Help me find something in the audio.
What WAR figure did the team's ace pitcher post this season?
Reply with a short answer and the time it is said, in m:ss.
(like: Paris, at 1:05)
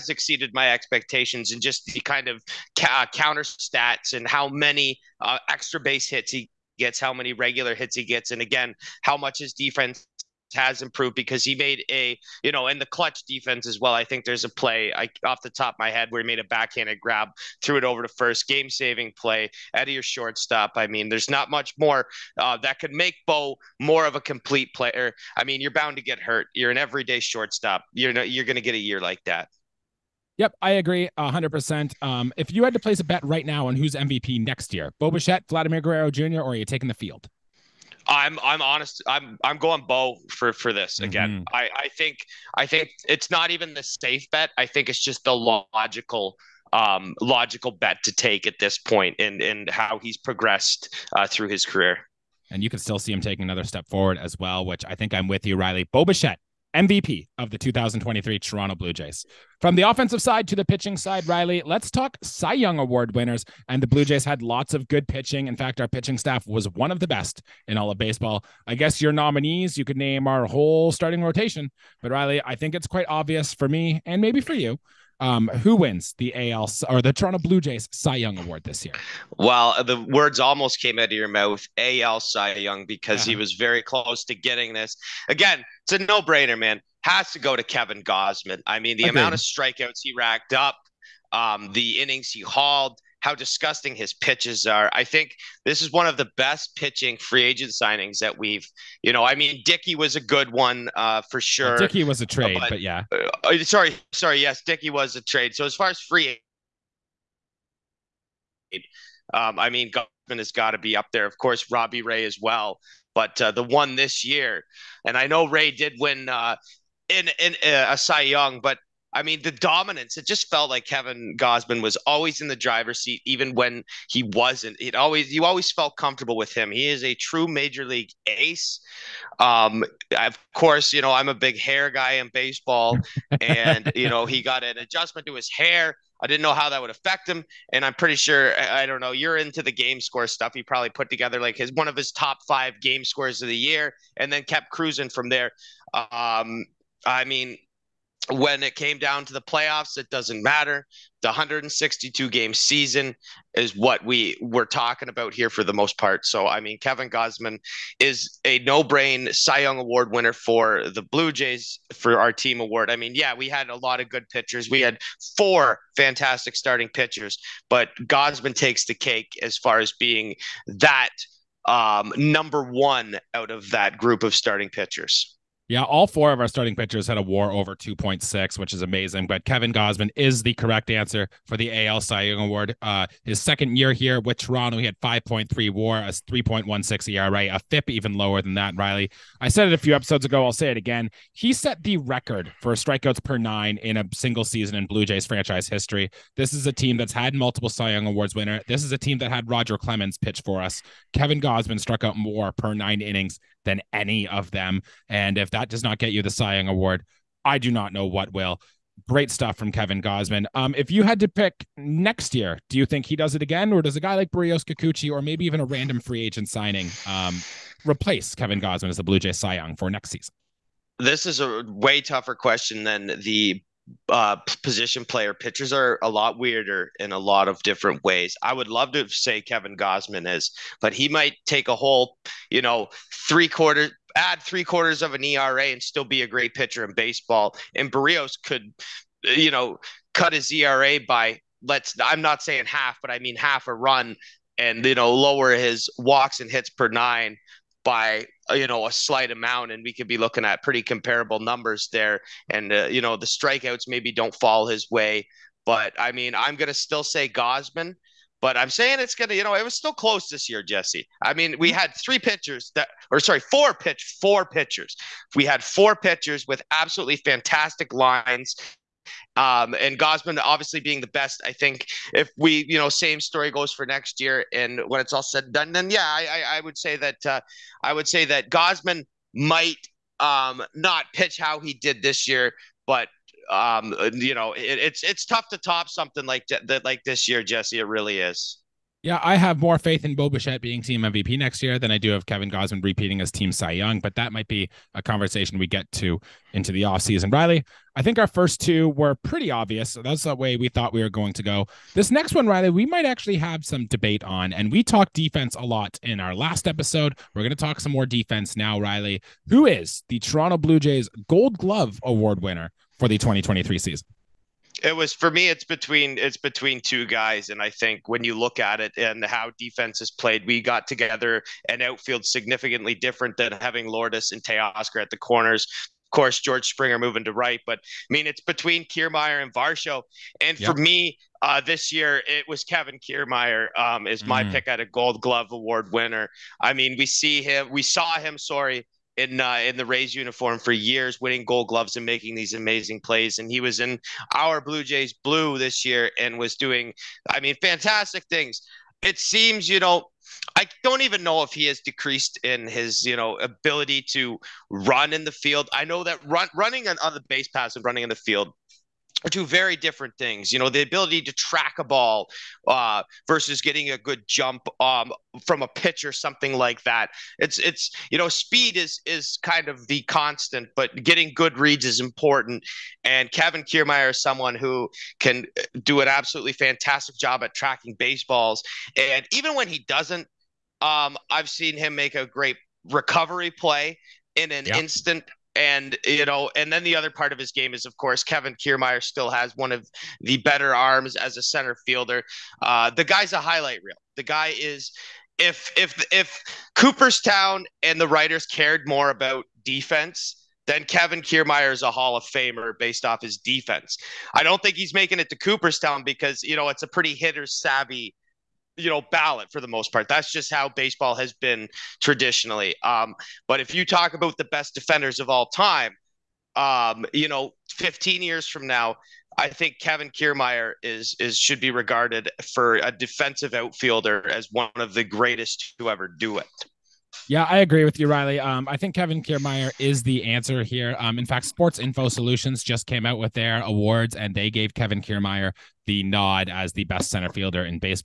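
5.3, at 3:04.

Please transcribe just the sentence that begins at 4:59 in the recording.
So that's the way we thought we were going to go.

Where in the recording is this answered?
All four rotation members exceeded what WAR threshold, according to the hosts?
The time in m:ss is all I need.
2:57.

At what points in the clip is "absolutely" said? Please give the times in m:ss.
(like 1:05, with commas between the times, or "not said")
4:26, 6:16.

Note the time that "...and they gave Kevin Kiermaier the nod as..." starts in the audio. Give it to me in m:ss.
7:14.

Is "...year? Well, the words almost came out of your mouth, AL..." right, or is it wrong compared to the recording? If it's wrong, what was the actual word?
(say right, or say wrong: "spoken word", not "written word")
right.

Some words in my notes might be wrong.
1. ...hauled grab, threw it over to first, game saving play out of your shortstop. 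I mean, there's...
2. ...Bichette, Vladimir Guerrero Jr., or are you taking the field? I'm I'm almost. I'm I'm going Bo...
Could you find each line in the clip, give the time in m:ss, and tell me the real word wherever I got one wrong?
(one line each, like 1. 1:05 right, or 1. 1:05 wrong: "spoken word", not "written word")
1. 0:16 wrong: "backhanded", not "hauled"
2. 0:35 wrong: "honest", not "almost".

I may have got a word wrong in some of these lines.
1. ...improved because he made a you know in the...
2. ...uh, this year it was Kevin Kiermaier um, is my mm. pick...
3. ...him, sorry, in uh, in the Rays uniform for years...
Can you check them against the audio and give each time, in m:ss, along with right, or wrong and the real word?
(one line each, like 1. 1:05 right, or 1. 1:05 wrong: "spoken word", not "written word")
1. 0:10 right
2. 5:31 right
3. 5:38 right.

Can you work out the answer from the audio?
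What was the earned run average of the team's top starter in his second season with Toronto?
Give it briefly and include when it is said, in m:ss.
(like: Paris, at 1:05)
3.16, at 3:05.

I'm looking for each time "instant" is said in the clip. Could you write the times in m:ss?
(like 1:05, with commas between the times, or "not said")
6:24.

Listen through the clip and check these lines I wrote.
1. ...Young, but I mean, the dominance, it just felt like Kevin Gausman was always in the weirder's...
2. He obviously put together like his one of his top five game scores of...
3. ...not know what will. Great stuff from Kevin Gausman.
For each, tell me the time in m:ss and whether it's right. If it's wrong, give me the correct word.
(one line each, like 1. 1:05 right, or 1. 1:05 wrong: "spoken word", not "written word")
1. 1:58 wrong: "driver", not "weirder"
2. 2:20 wrong: "probably", not "obviously"
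3. 3:27 right.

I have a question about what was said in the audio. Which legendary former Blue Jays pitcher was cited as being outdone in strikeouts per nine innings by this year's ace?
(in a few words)
Roger Clemens.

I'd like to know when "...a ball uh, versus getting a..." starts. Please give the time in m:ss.
6:01.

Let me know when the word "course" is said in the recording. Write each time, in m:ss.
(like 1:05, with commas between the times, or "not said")
1:51, 2:10, 5:26, 6:27.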